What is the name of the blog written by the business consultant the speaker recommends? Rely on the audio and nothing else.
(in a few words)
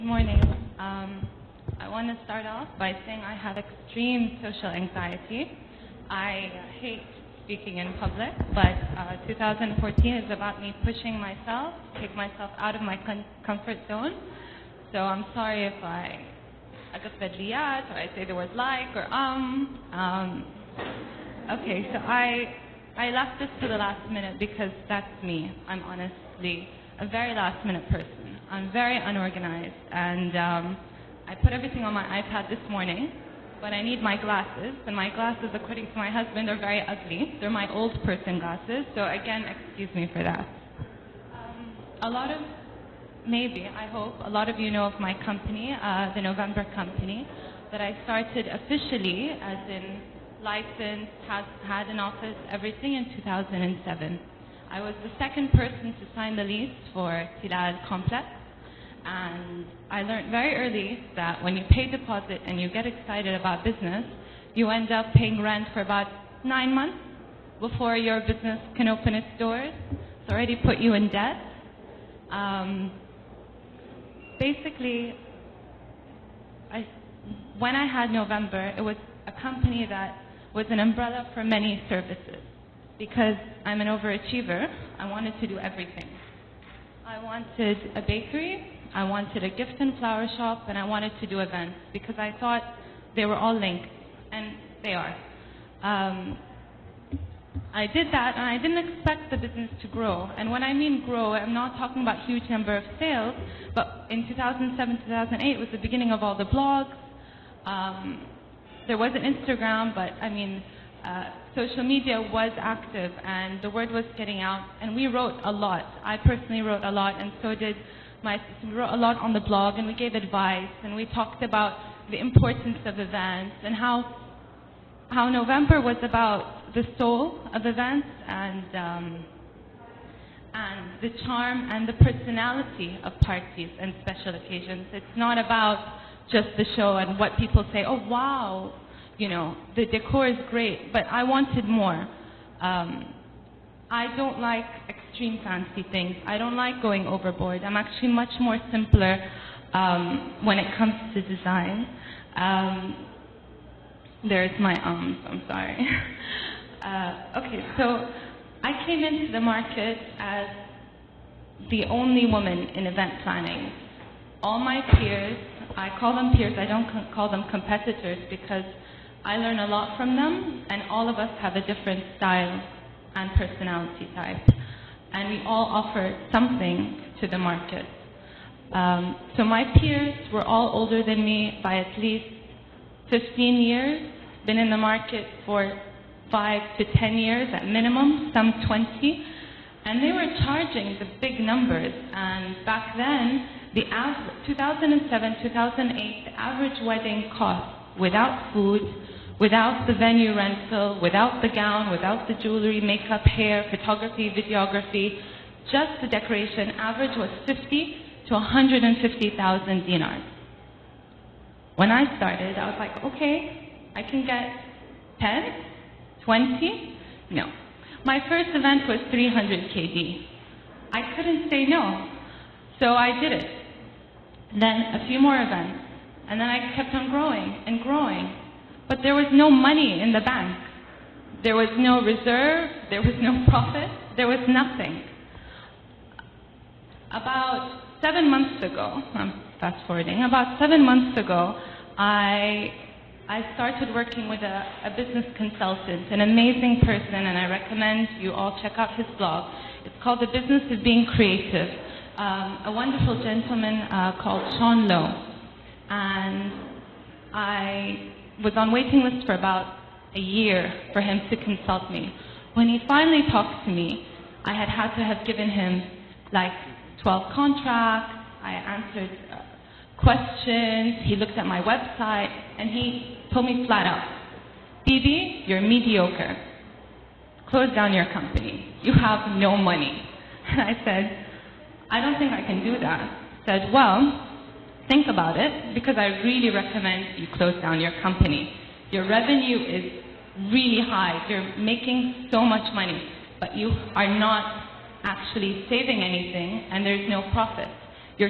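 The Business of Being Creative.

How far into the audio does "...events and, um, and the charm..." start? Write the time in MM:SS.
02:07.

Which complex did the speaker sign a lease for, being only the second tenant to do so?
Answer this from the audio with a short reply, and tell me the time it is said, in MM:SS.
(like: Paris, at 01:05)
Tilal Complex, at 00:57.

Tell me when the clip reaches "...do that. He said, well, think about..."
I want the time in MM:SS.
04:42.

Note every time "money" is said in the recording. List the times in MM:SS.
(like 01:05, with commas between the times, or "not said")
03:49, 04:39, 04:52.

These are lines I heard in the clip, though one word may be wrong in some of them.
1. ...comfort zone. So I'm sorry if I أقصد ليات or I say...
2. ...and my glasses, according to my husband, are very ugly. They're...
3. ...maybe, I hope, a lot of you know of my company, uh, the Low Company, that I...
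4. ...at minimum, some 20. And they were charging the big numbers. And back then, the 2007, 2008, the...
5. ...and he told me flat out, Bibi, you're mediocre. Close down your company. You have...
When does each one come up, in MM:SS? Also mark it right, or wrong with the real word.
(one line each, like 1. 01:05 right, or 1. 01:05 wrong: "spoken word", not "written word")
1. 00:13 right
2. 00:34 right
3. 00:43 wrong: "November", not "Low"
4. 03:07 right
5. 04:32 right.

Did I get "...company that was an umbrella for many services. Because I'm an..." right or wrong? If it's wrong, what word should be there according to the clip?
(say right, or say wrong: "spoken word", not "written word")
right.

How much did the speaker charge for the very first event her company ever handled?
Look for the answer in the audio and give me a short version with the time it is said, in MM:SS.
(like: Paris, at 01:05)
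300 KD, at 03:39.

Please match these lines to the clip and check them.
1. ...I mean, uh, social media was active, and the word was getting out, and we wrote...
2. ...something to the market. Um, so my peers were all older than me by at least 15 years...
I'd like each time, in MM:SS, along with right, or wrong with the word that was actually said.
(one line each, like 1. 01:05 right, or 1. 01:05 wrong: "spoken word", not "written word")
1. 01:50 right
2. 02:56 right.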